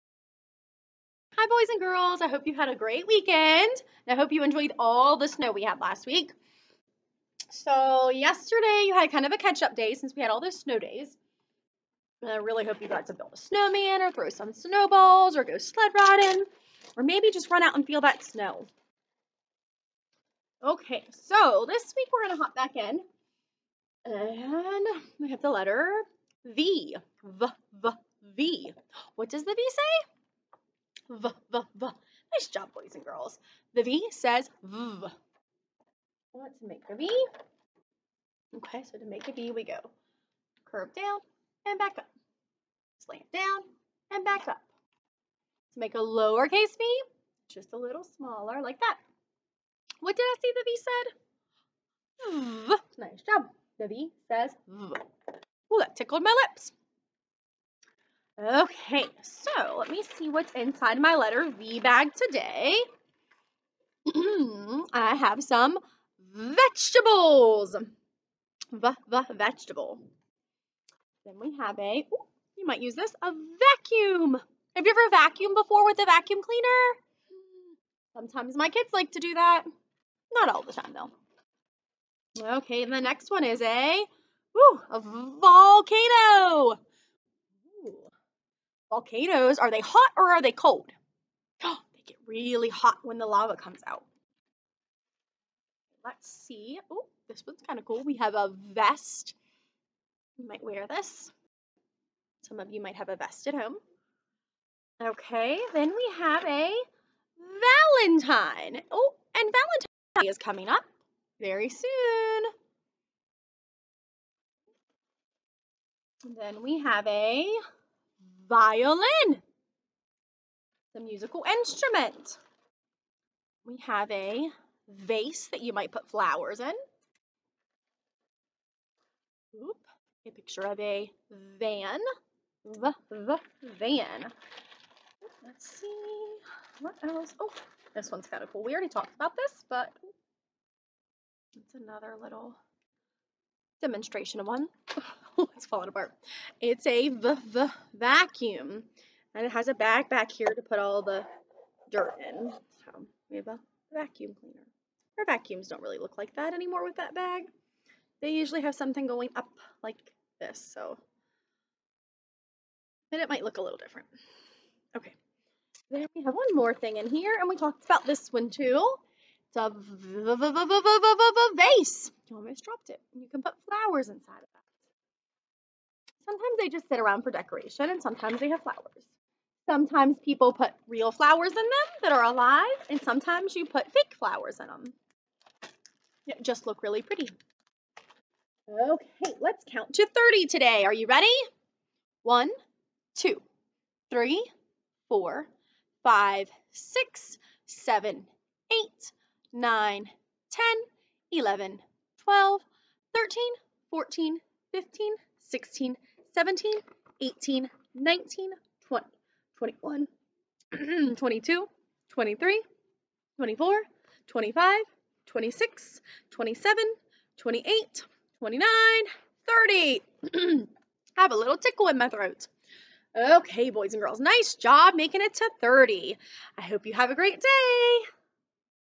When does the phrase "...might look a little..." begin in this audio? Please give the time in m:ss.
2:43.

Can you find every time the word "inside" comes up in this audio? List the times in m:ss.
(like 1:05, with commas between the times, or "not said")
1:00, 2:54.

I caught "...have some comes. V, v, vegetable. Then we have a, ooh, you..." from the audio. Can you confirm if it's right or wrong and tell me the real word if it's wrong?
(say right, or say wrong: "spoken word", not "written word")
wrong: "vegetables", not "comes".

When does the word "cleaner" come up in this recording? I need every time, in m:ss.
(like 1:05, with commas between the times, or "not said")
1:16, 2:34.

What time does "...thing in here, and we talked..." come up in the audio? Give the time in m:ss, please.
2:46.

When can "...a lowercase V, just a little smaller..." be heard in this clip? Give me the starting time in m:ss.
0:45.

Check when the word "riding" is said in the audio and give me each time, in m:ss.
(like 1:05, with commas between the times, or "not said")
0:15.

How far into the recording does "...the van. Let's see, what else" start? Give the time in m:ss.
2:13.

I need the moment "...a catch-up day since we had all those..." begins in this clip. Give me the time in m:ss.
0:09.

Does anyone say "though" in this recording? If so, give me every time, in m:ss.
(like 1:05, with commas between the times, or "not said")
1:20.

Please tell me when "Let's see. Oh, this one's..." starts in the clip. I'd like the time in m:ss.
1:36.